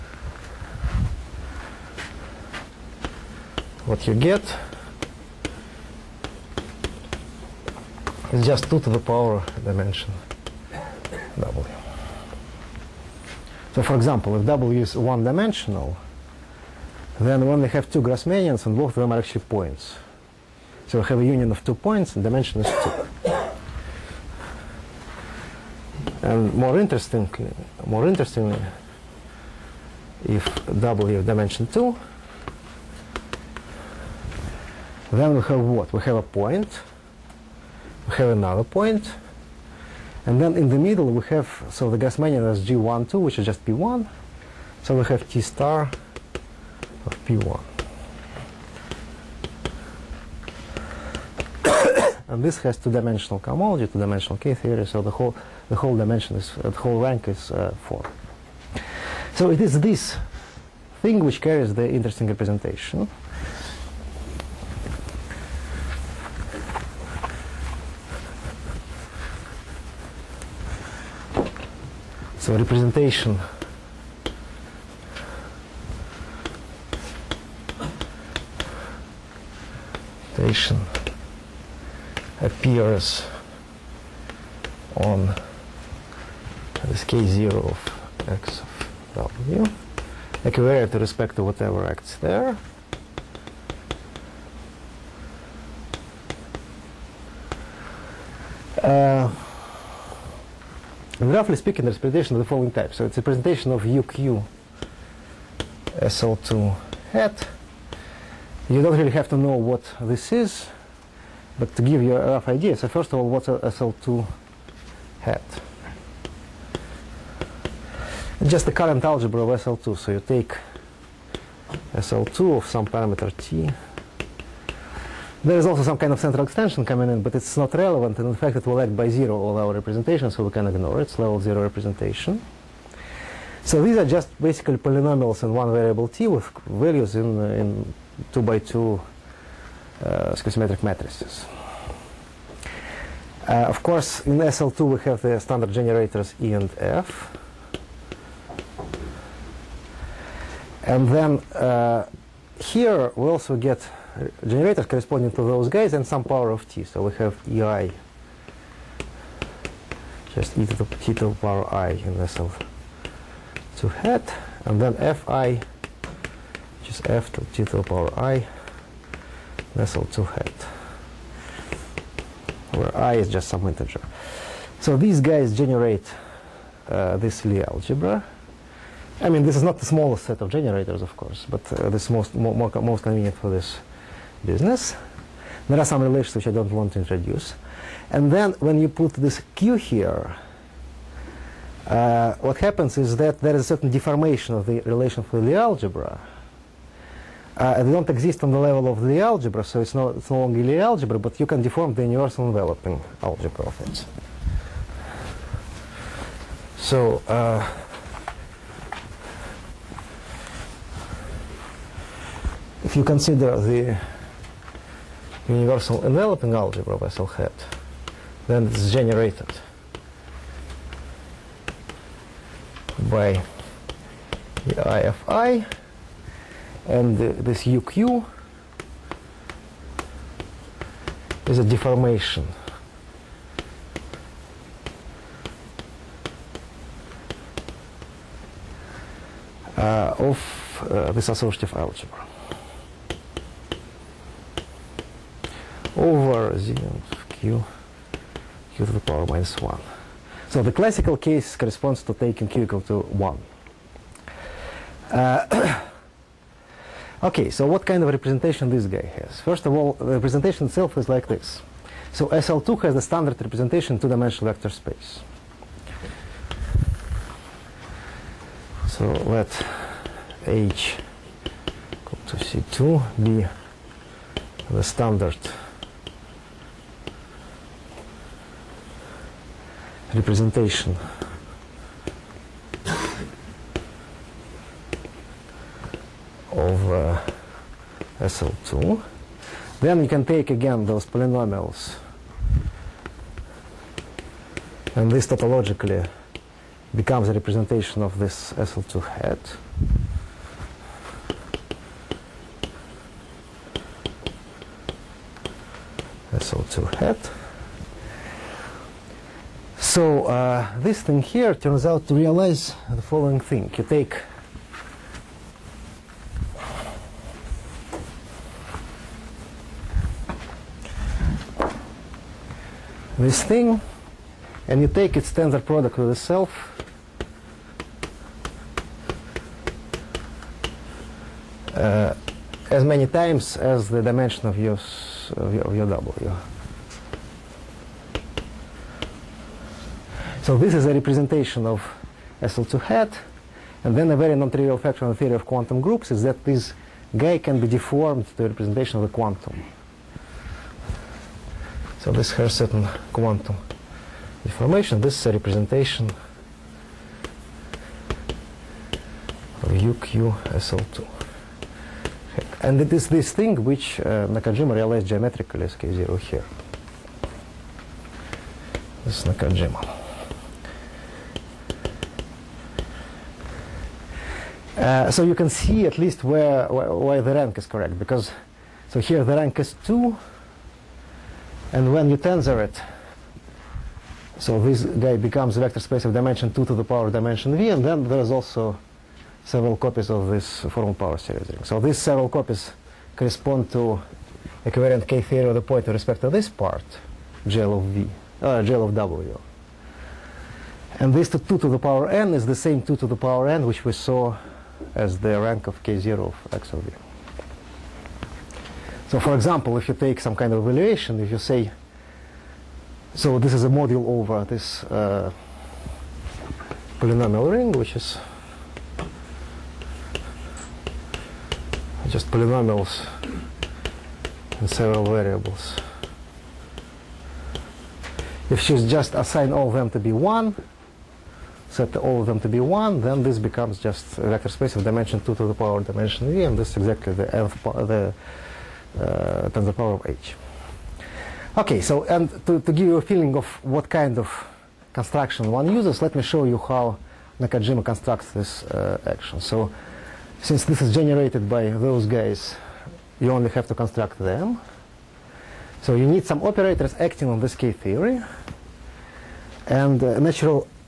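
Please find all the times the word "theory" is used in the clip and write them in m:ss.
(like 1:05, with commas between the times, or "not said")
0:54, 5:45, 6:35, 7:37.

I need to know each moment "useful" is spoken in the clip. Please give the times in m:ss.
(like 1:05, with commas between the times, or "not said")
not said.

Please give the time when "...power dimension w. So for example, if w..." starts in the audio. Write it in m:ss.
0:08.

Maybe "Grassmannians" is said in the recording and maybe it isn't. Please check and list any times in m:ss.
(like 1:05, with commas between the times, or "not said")
0:18, 0:41.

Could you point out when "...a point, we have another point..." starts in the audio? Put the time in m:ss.
0:36.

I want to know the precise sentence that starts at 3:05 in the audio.
There are some relations which I don't want to introduce.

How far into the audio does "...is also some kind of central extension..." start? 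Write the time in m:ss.
2:05.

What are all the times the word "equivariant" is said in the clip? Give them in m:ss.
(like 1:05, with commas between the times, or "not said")
1:30, 6:34.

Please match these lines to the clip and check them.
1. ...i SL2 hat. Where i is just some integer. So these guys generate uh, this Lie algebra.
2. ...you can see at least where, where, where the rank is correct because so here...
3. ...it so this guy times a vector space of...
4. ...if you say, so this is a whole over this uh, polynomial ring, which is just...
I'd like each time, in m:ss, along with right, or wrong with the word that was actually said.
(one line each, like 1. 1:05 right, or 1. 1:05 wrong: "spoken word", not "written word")
1. 2:48 right
2. 6:15 right
3. 6:22 wrong: "becomes", not "times"
4. 6:51 wrong: "module", not "whole".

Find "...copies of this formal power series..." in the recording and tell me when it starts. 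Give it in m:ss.
6:29.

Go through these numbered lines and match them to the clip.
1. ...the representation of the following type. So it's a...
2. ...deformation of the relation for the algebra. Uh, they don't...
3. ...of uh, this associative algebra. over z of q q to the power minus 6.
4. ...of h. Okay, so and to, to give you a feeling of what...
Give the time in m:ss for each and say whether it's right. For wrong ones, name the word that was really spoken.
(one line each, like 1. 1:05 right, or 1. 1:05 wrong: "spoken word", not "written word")
1. 1:41 right
2. 3:13 right
3. 4:00 wrong: "1", not "6"
4. 7:19 right.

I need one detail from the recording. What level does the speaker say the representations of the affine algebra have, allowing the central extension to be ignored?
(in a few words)
Level zero.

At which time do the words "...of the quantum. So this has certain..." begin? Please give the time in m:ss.
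5:48.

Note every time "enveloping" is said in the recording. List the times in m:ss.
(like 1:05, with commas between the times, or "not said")
3:22, 3:36.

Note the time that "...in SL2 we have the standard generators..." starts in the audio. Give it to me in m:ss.
2:24.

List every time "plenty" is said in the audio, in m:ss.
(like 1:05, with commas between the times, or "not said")
not said.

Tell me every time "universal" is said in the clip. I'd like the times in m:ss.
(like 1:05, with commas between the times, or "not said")
3:22, 3:35.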